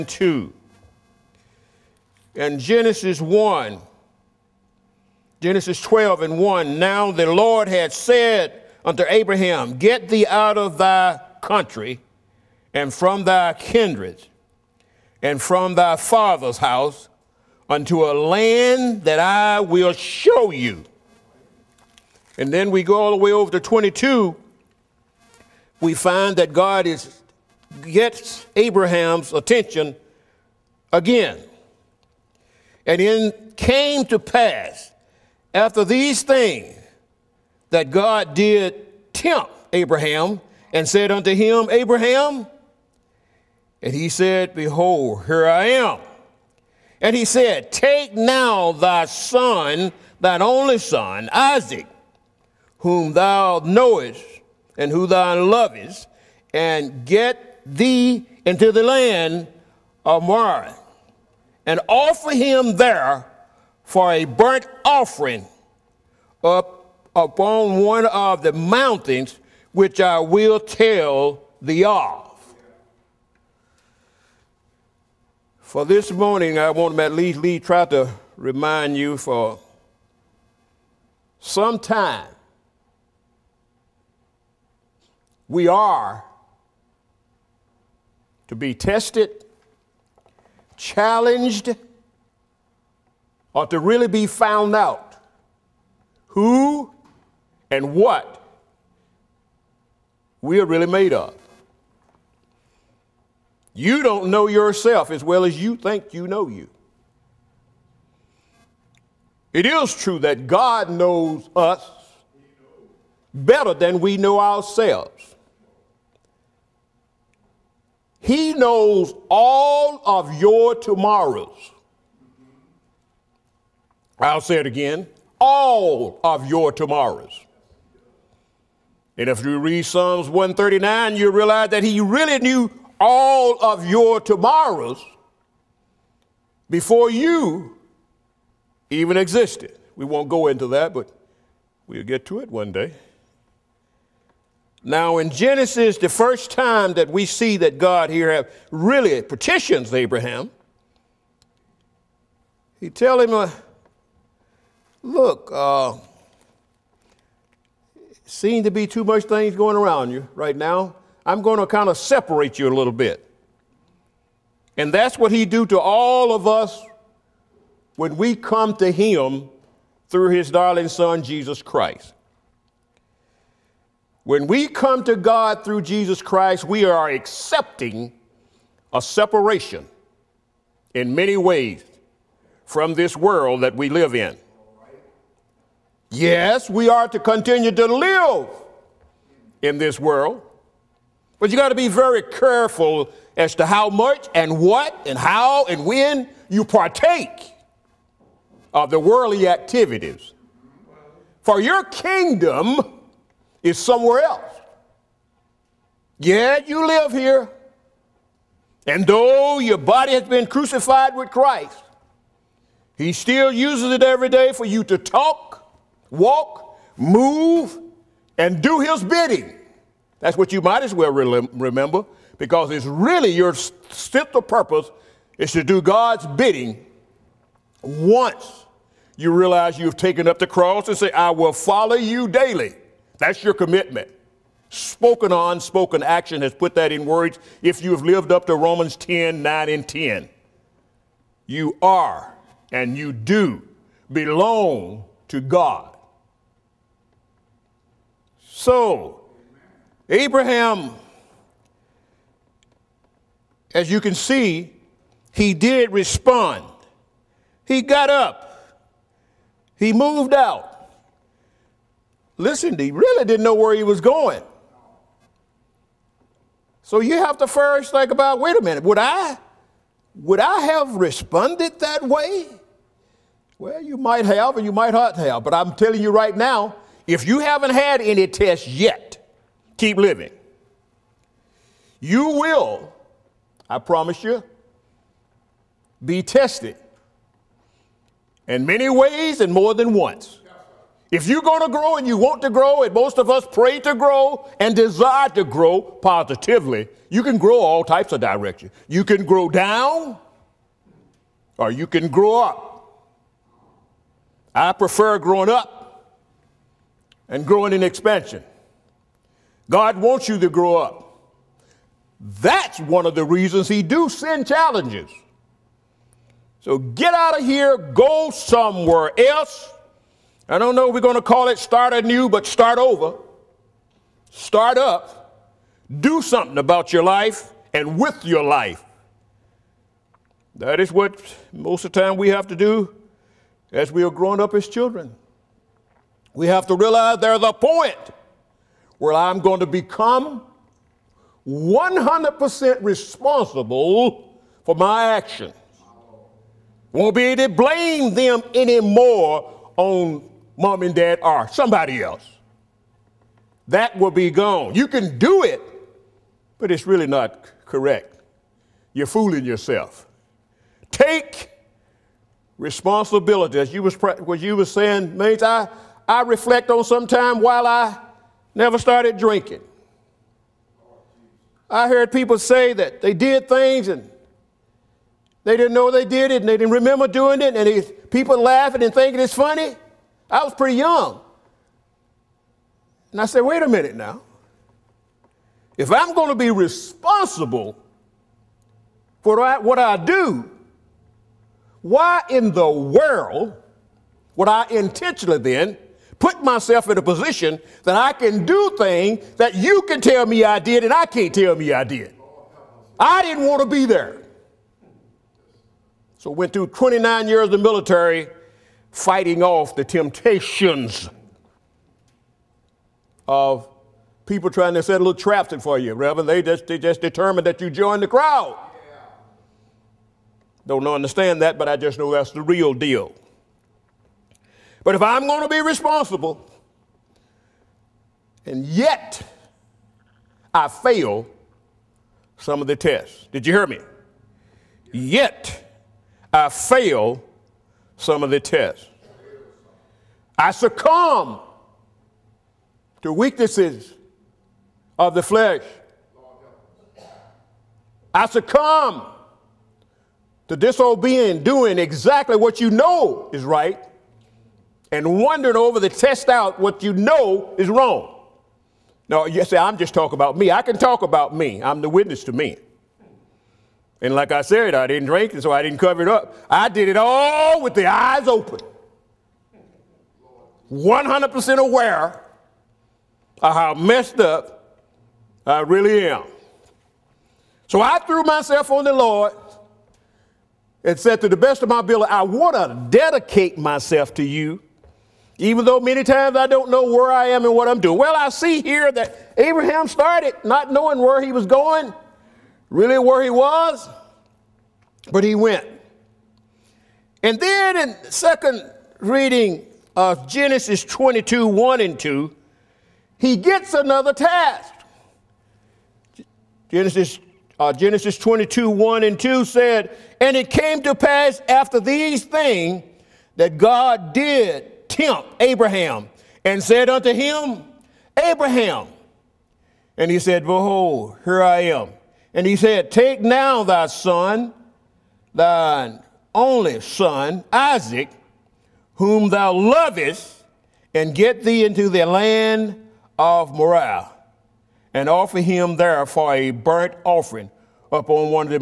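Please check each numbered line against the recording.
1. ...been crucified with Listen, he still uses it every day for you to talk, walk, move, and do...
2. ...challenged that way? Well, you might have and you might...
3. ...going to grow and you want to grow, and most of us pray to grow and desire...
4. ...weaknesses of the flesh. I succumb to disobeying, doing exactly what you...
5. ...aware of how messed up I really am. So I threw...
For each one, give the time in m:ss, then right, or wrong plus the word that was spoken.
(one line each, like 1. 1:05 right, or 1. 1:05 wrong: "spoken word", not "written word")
1. 3:30 wrong: "Christ", not "Listen"
2. 4:30 wrong: "responded", not "challenged"
3. 4:51 right
4. 7:23 right
5. 7:51 right.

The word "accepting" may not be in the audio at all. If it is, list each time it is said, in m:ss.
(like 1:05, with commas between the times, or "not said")
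2:57.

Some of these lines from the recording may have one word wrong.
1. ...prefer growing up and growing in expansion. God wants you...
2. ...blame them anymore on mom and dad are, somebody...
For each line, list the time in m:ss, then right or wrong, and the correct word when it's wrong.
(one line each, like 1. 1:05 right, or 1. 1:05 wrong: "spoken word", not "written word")
1. 5:04 right
2. 5:47 right.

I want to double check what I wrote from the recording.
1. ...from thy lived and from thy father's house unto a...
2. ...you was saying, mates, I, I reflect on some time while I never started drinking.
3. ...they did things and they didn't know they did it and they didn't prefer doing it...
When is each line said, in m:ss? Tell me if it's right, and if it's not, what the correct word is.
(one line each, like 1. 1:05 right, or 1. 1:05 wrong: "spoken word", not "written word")
1. 0:12 wrong: "kindred", not "lived"
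2. 6:04 right
3. 6:13 wrong: "remember", not "prefer".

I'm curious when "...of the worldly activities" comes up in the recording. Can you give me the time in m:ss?
3:18.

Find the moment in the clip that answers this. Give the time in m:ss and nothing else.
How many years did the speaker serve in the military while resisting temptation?
6:46.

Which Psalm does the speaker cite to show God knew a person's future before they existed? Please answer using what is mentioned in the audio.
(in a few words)
Psalms 139.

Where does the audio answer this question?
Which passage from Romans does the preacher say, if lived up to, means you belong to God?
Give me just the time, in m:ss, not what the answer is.
3:58.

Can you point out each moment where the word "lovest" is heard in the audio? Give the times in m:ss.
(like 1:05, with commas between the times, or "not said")
0:55, 8:49.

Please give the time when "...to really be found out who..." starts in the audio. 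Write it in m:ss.
1:33.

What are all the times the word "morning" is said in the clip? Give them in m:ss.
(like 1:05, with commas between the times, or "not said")
1:16.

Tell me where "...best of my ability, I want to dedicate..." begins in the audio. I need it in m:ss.
8:01.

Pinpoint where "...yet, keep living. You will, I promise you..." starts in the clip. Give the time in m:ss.
4:38.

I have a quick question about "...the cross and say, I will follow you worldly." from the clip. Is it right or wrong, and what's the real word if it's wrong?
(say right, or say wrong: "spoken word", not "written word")
wrong: "daily", not "worldly".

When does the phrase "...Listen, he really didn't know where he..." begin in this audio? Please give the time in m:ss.
4:22.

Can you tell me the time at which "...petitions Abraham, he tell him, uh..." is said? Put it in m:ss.
2:29.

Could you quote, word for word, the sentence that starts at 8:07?
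Well, I see here that Abraham started not knowing where he was going really where he was, but he went.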